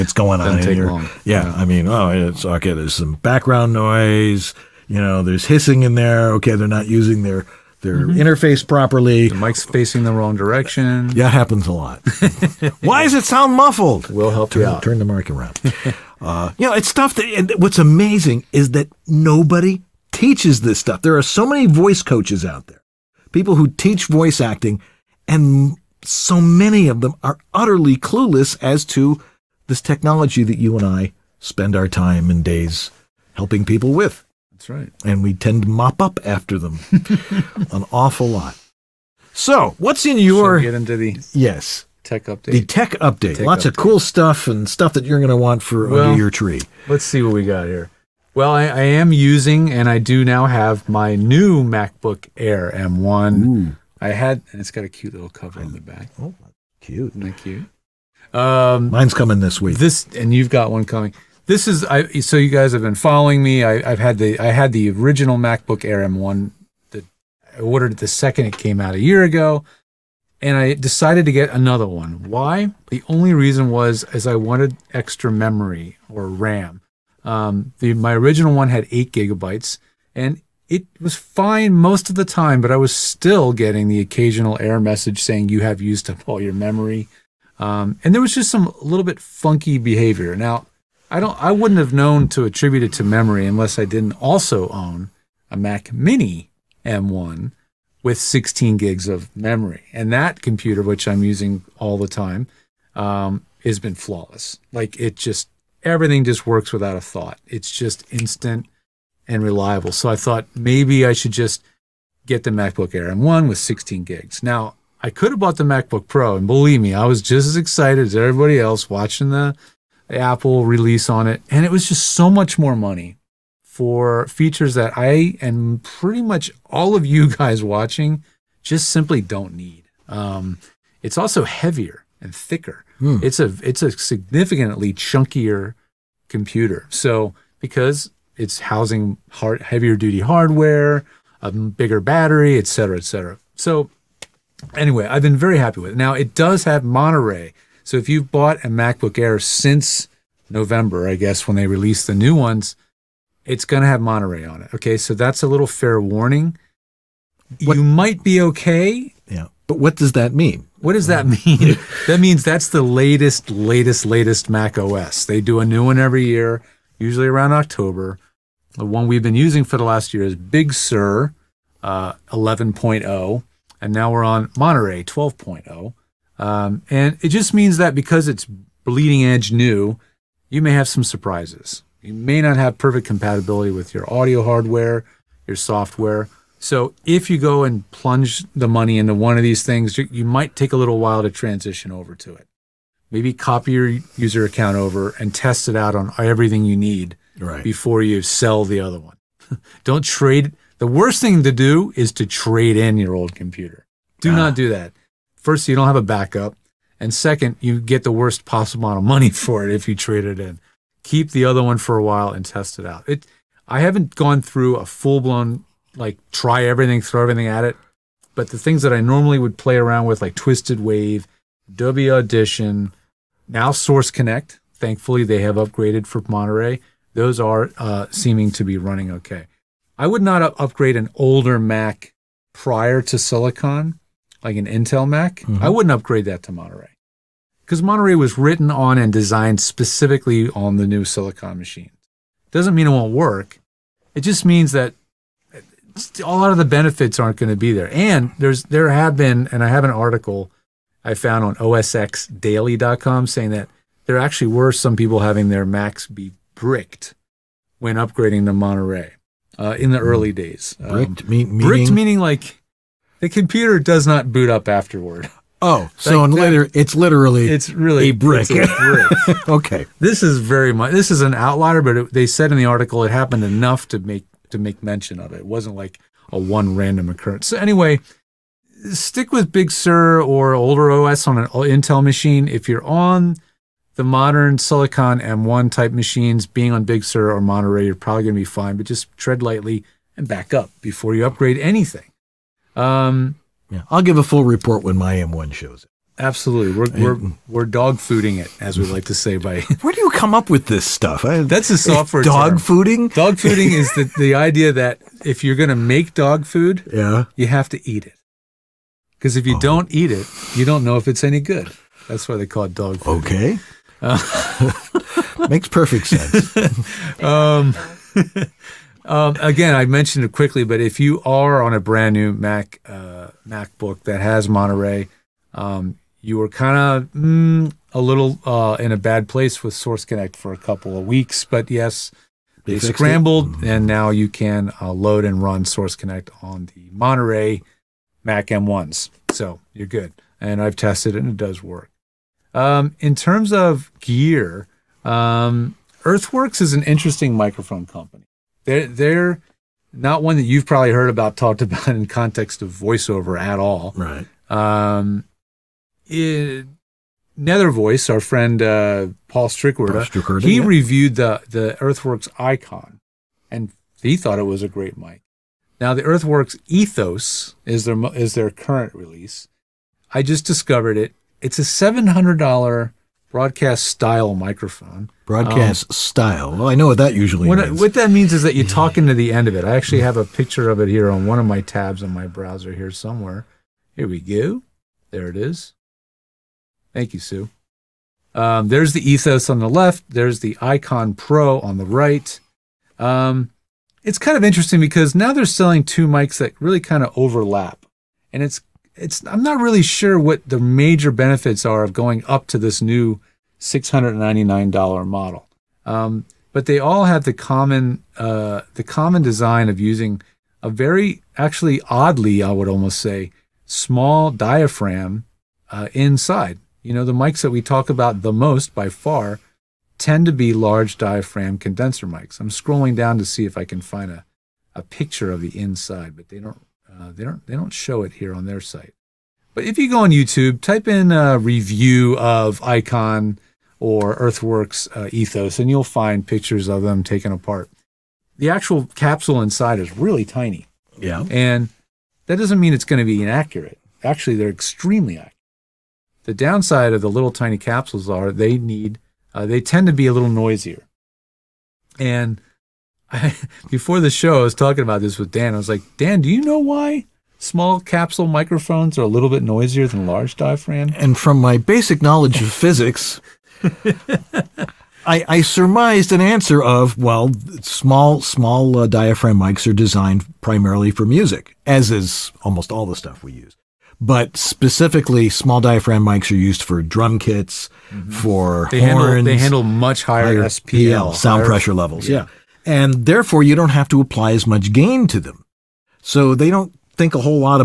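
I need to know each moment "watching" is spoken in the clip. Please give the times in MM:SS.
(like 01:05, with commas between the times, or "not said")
01:58, 02:07.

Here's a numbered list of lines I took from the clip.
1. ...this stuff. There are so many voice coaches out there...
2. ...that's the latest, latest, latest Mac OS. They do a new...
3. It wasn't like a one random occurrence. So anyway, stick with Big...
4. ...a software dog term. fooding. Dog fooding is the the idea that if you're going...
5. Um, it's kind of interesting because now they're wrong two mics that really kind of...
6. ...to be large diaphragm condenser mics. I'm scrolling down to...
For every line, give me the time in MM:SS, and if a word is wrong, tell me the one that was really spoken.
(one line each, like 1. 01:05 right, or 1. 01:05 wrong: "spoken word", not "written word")
1. 00:20 right
2. 02:42 right
3. 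04:35 right
4. 05:01 right
5. 06:32 wrong: "selling", not "wrong"
6. 07:00 right.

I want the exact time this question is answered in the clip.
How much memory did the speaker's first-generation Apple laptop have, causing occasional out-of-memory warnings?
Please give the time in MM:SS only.
01:18.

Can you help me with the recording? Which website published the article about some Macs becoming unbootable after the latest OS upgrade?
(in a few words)
OSXDaily.com.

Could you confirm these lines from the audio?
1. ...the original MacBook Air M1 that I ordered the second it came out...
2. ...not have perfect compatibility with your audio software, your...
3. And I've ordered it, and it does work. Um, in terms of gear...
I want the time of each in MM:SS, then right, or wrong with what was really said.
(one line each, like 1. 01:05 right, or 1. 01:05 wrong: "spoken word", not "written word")
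1. 01:04 right
2. 03:02 wrong: "hardware", not "software"
3. 05:40 wrong: "tested", not "ordered".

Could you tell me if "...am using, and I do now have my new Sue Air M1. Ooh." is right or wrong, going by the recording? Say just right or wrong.
wrong.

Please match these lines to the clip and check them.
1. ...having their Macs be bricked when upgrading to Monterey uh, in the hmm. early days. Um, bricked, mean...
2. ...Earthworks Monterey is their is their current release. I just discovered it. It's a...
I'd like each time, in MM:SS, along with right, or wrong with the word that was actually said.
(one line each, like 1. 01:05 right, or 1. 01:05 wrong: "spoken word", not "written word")
1. 04:15 right
2. 06:06 wrong: "Ethos", not "Monterey".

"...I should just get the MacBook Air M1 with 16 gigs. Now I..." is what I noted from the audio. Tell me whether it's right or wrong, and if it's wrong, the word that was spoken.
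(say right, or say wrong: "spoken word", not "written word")
right.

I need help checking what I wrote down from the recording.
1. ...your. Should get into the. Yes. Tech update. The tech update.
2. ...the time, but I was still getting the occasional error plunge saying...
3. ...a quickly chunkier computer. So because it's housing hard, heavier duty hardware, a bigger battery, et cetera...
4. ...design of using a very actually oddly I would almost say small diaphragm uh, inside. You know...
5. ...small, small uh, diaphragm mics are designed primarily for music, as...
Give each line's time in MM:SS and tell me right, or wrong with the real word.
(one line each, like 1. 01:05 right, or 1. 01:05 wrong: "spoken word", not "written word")
1. 00:40 right
2. 01:22 wrong: "message", not "plunge"
3. 02:13 wrong: "significantly", not "quickly"
4. 06:49 right
5. 07:47 right.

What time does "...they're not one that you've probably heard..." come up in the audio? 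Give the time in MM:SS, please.
05:48.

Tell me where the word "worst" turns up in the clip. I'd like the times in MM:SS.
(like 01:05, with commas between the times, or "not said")
03:20, 03:28.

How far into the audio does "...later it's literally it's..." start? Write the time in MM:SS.
04:26.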